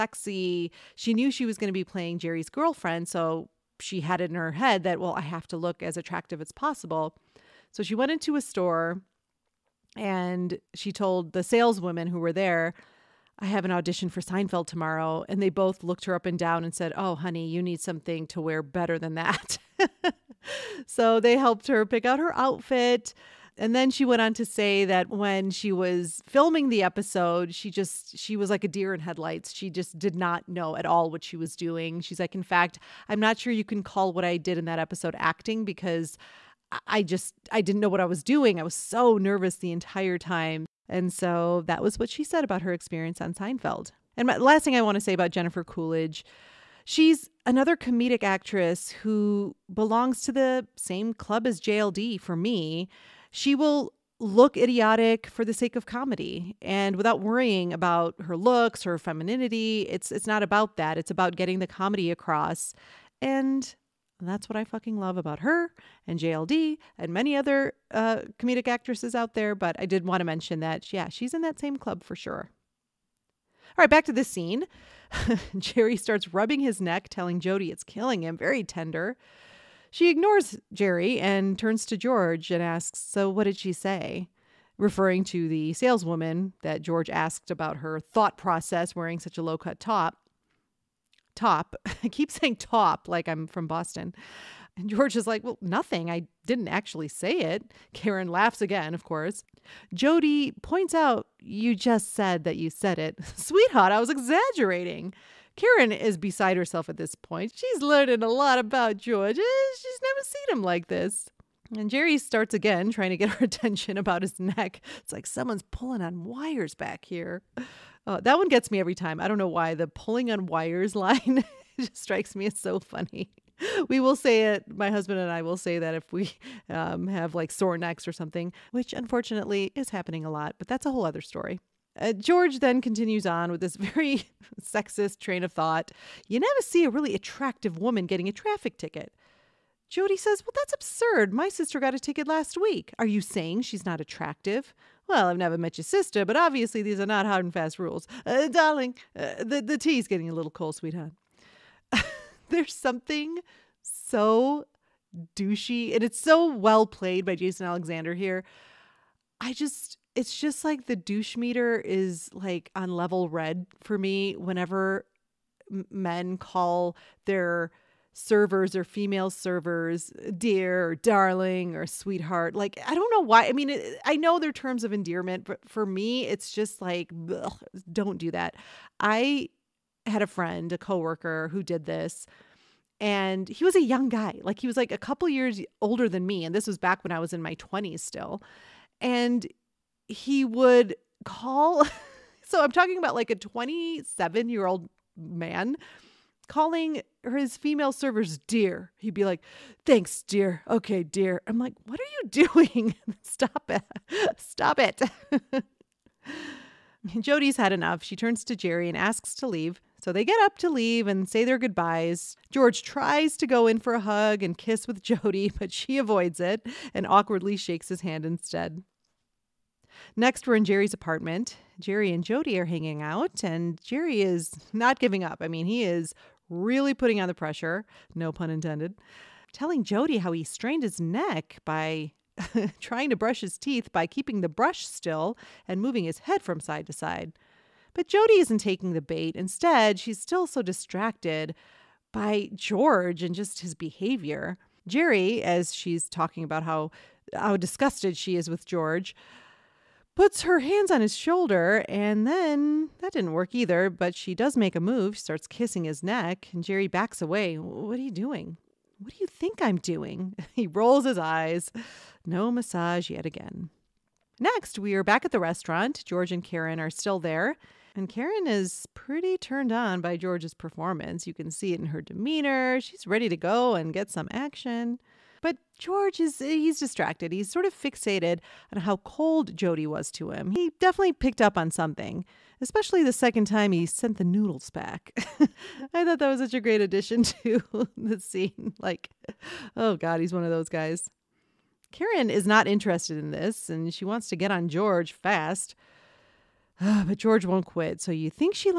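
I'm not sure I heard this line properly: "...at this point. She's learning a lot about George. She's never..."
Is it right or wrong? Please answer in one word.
right.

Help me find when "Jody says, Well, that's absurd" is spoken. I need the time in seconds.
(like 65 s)
139 s.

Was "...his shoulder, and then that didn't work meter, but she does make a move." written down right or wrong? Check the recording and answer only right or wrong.
wrong.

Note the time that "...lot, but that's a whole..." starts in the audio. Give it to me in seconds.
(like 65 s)
130 s.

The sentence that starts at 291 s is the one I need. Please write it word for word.
Karen is not interested in this and she wants to get on George fast.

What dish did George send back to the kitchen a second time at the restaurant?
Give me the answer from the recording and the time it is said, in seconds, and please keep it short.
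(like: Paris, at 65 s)
Noodles, at 284 s.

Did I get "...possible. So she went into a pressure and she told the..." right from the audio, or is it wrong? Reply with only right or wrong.
wrong.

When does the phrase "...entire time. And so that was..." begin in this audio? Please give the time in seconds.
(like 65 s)
39 s.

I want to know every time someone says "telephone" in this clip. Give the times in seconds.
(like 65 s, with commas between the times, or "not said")
not said.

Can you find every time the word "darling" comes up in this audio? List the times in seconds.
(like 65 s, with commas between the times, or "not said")
148 s, 170 s.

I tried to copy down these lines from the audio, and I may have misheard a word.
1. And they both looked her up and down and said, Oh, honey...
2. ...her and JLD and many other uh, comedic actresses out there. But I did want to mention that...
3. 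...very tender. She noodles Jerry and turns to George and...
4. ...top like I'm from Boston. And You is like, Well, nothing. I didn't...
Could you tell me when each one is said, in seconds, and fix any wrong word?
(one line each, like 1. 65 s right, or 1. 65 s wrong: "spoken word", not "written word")
1. 15 s right
2. 65 s right
3. 78 s wrong: "ignores", not "noodles"
4. 92 s wrong: "George", not "You".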